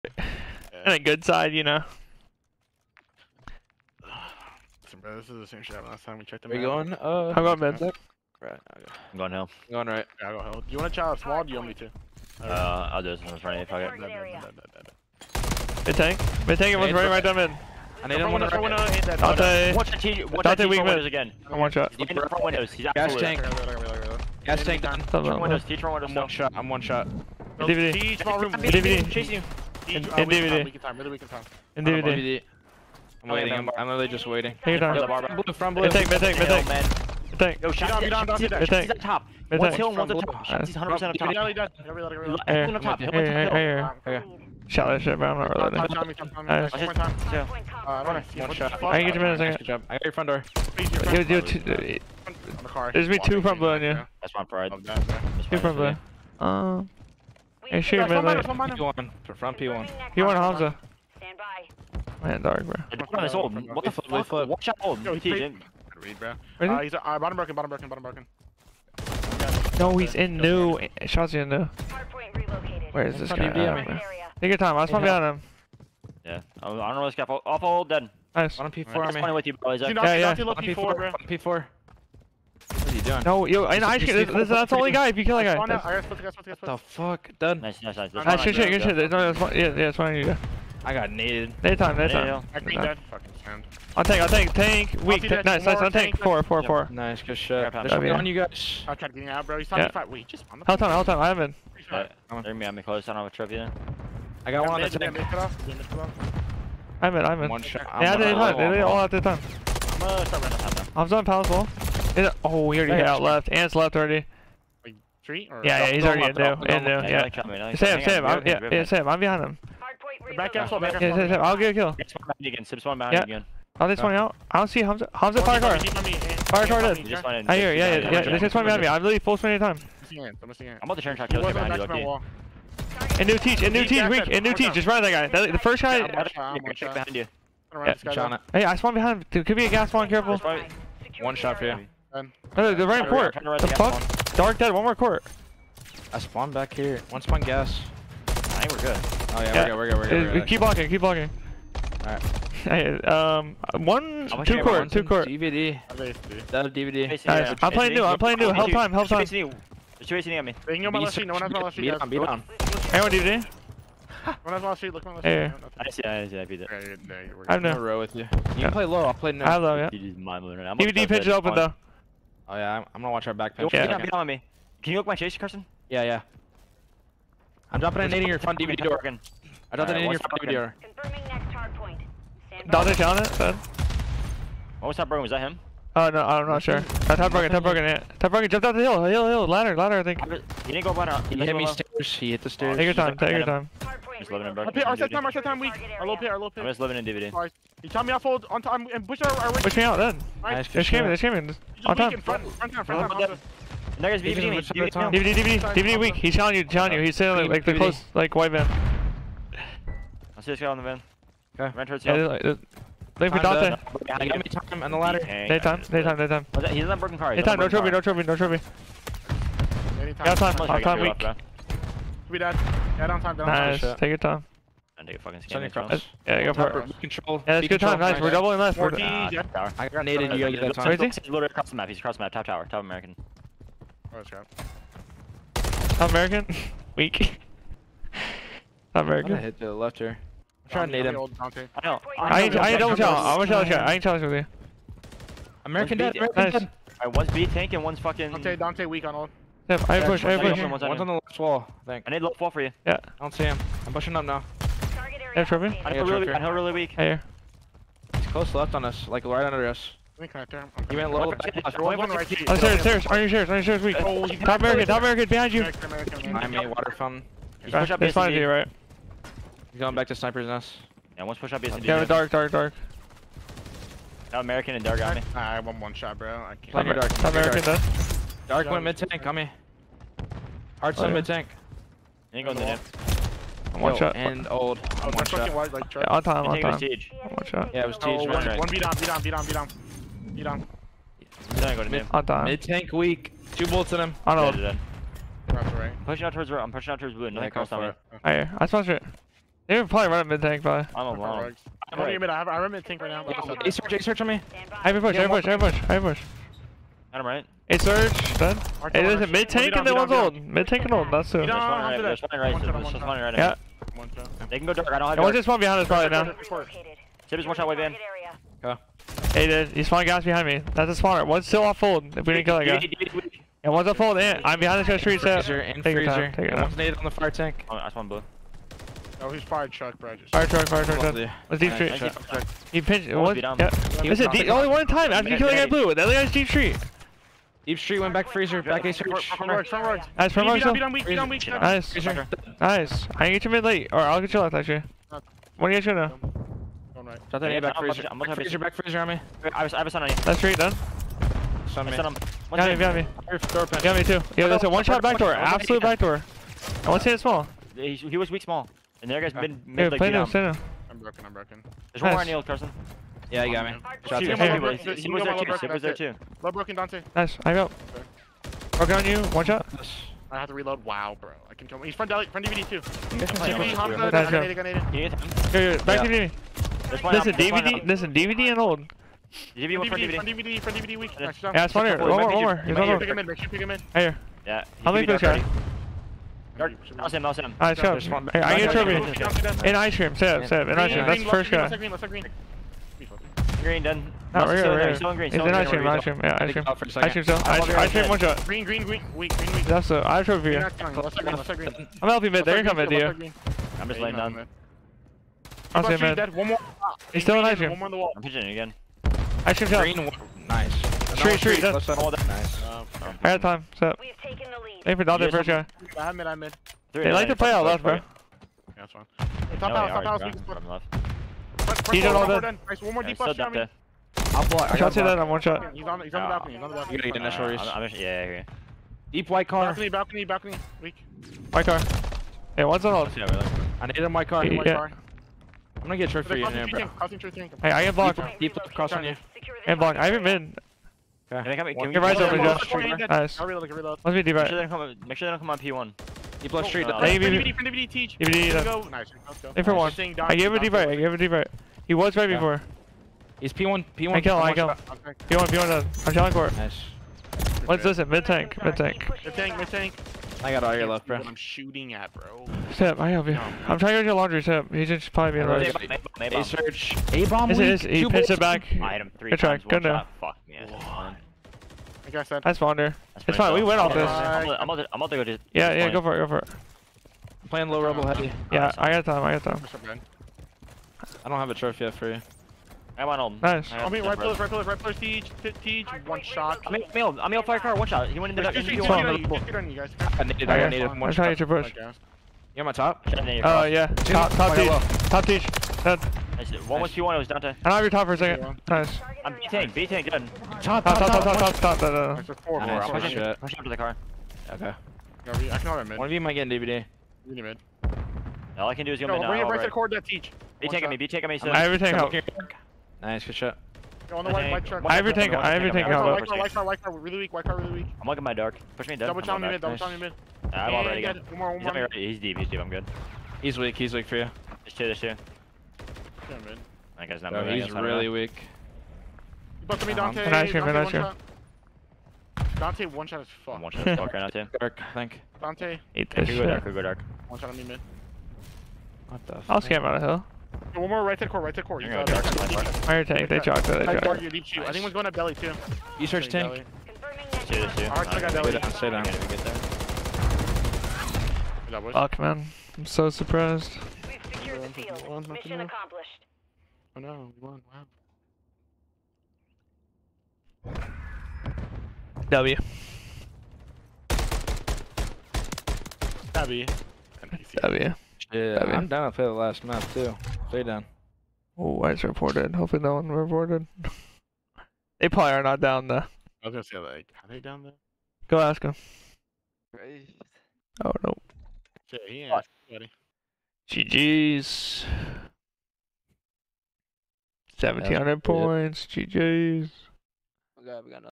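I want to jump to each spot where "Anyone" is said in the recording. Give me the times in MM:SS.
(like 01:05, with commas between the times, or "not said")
02:42.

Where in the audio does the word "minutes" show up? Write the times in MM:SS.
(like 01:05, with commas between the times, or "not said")
not said.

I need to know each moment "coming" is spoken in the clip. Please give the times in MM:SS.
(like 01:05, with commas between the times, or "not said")
06:42, 08:46.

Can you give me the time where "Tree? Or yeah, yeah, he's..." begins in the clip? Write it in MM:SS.
01:55.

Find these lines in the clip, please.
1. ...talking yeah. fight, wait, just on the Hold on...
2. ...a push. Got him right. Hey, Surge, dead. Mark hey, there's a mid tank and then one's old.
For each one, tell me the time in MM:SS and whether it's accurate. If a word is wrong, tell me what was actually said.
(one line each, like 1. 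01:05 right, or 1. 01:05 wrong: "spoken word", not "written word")
1. 01:39 right
2. 05:06 right.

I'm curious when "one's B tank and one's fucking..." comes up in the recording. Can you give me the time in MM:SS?
04:07.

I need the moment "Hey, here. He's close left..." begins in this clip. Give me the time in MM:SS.
04:16.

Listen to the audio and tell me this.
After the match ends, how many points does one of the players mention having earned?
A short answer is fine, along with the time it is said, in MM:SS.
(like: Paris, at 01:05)
1700, at 09:47.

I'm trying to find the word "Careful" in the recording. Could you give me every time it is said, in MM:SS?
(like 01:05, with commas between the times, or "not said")
02:20.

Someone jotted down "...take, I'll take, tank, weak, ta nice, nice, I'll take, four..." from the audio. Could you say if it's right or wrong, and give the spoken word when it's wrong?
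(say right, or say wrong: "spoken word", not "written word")
right.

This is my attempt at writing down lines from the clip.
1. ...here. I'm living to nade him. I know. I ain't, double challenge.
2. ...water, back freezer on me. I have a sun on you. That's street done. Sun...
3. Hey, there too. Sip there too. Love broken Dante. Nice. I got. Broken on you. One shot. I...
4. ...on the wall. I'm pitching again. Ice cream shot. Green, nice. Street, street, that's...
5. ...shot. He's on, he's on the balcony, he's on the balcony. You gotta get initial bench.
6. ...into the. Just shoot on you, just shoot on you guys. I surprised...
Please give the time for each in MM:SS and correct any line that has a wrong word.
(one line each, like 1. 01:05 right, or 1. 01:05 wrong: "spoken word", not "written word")
1. 03:59 wrong: "trying", not "living"
2. 05:48 wrong: "freezer", not "water"
3. 06:04 right
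4. 06:47 right
5. 07:05 wrong: "reach", not "bench"
6. 08:08 wrong: "needed", not "surprised".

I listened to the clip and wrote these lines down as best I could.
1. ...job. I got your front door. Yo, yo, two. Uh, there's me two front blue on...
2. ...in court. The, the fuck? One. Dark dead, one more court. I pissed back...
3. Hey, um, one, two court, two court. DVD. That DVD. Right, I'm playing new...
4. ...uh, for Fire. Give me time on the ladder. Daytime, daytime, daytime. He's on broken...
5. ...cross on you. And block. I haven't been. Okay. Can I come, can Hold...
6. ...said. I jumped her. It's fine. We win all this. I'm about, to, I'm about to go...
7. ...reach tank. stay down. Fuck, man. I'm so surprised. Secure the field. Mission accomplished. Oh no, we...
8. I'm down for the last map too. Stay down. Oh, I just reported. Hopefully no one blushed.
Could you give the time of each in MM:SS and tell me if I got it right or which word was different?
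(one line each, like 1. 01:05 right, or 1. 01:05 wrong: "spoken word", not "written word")
1. 00:49 right
2. 02:23 wrong: "spawned", not "pissed"
3. 02:32 right
4. 03:33 wrong: "Dante", not "Fire"
5. 07:18 wrong: "Your", not "Hold"
6. 07:52 wrong: "spawned", not "jumped"
7. 09:06 wrong: "search", not "reach"
8. 09:28 wrong: "reported", not "blushed".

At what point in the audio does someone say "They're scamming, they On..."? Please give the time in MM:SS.
03:20.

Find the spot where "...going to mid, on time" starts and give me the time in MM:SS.
04:51.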